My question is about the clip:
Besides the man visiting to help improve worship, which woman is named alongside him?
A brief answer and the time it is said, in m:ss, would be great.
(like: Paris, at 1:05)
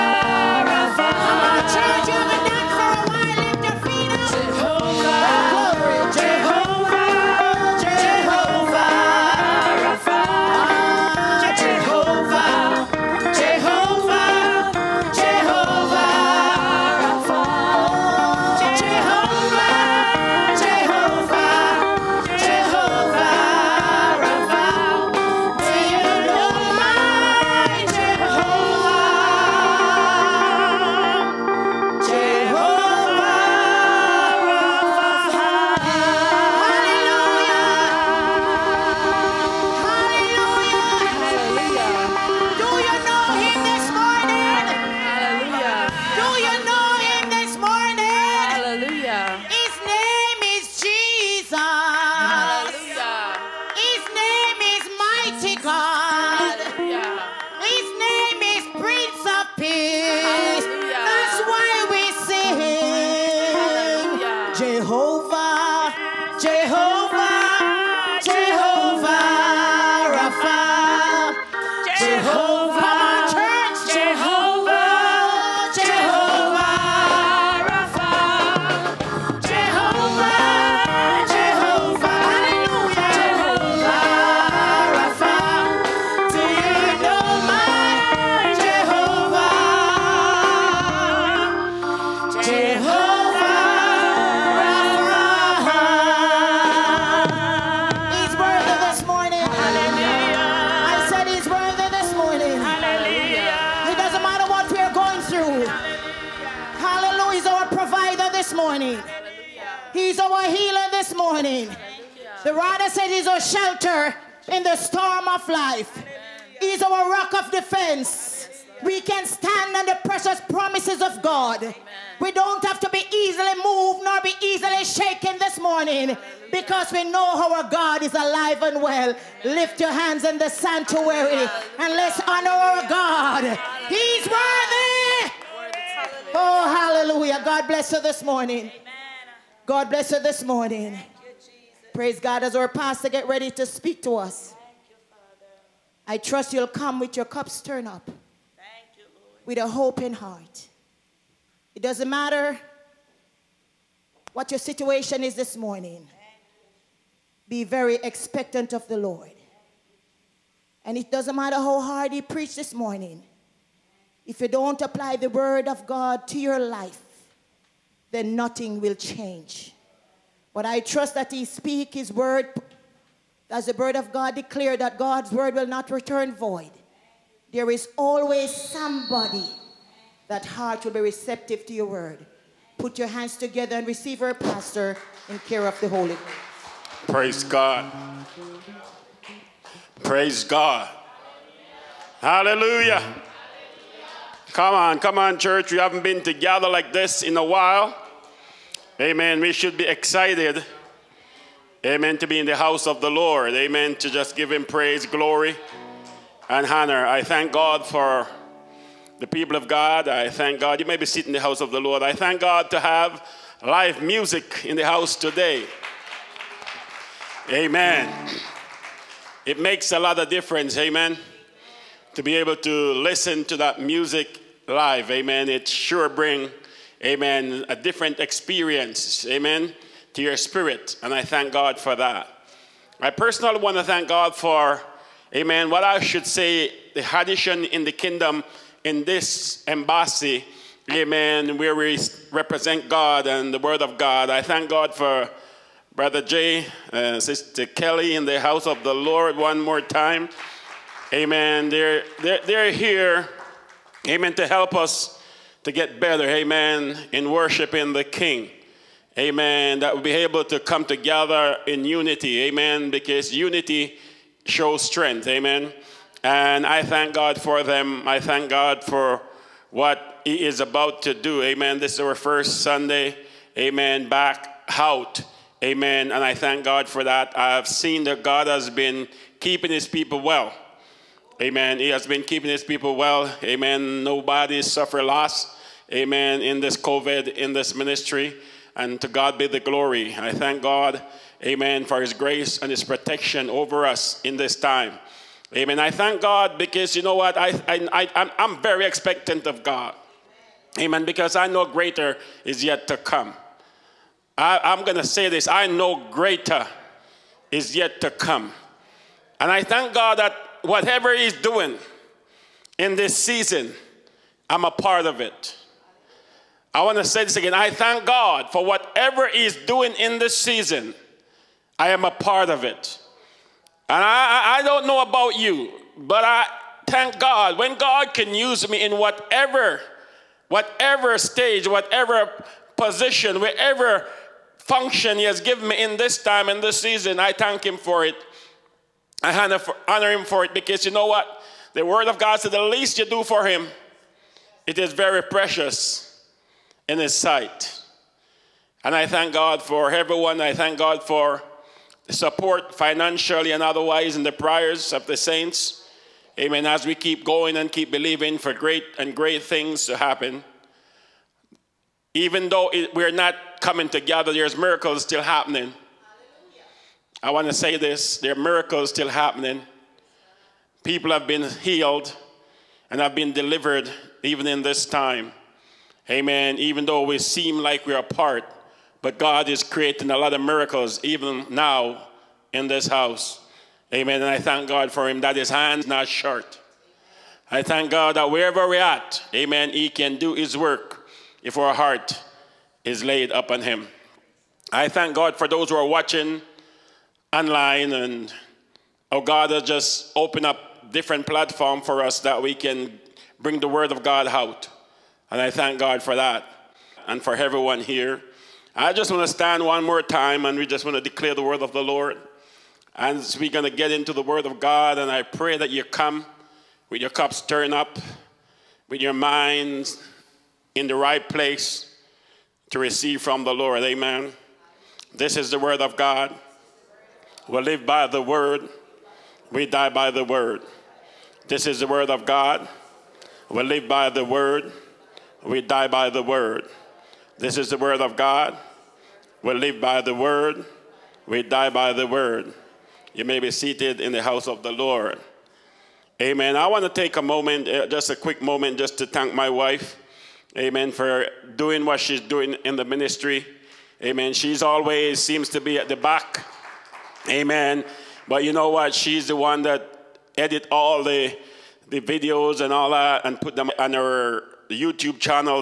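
Sister Kelly, at 4:07.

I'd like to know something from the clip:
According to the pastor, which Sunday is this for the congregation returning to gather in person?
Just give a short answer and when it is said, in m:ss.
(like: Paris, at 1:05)
first Sunday, at 4:32.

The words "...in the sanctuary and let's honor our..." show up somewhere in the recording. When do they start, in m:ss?
2:10.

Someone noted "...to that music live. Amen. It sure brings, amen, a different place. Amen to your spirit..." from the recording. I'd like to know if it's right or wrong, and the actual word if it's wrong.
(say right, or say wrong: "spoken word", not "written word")
wrong: "experience", not "place".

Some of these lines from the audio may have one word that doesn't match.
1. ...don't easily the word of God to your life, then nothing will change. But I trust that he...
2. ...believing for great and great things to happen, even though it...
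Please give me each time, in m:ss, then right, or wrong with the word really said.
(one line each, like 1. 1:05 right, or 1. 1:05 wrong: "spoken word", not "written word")
1. 2:44 wrong: "apply", not "easily"
2. 5:57 right.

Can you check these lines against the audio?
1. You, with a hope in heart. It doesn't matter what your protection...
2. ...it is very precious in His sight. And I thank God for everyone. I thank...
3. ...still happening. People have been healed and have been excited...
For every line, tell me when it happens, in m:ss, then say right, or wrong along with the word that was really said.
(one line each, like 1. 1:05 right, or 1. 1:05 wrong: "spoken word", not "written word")
1. 2:28 wrong: "situation", not "protection"
2. 5:44 right
3. 6:08 wrong: "delivered", not "excited".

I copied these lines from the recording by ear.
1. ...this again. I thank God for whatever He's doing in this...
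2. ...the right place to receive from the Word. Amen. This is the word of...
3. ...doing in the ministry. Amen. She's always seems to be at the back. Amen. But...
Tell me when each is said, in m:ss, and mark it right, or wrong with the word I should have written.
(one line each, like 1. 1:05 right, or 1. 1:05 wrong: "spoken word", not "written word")
1. 5:17 right
2. 7:00 wrong: "Lord", not "Word"
3. 7:32 right.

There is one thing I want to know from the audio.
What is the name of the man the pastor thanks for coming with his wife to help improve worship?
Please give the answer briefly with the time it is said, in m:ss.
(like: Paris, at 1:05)
Jay, at 4:05.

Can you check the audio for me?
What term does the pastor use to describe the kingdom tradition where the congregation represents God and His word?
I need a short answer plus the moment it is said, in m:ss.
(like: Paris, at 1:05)
embassy, at 3:59.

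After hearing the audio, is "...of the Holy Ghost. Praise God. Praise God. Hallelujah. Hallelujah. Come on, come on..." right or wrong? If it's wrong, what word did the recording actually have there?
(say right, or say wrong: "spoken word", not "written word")
right.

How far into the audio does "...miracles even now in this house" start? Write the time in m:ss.
6:20.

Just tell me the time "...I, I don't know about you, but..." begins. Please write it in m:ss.
5:24.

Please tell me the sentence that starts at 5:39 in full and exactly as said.
I honor, honor Him for it because you know what?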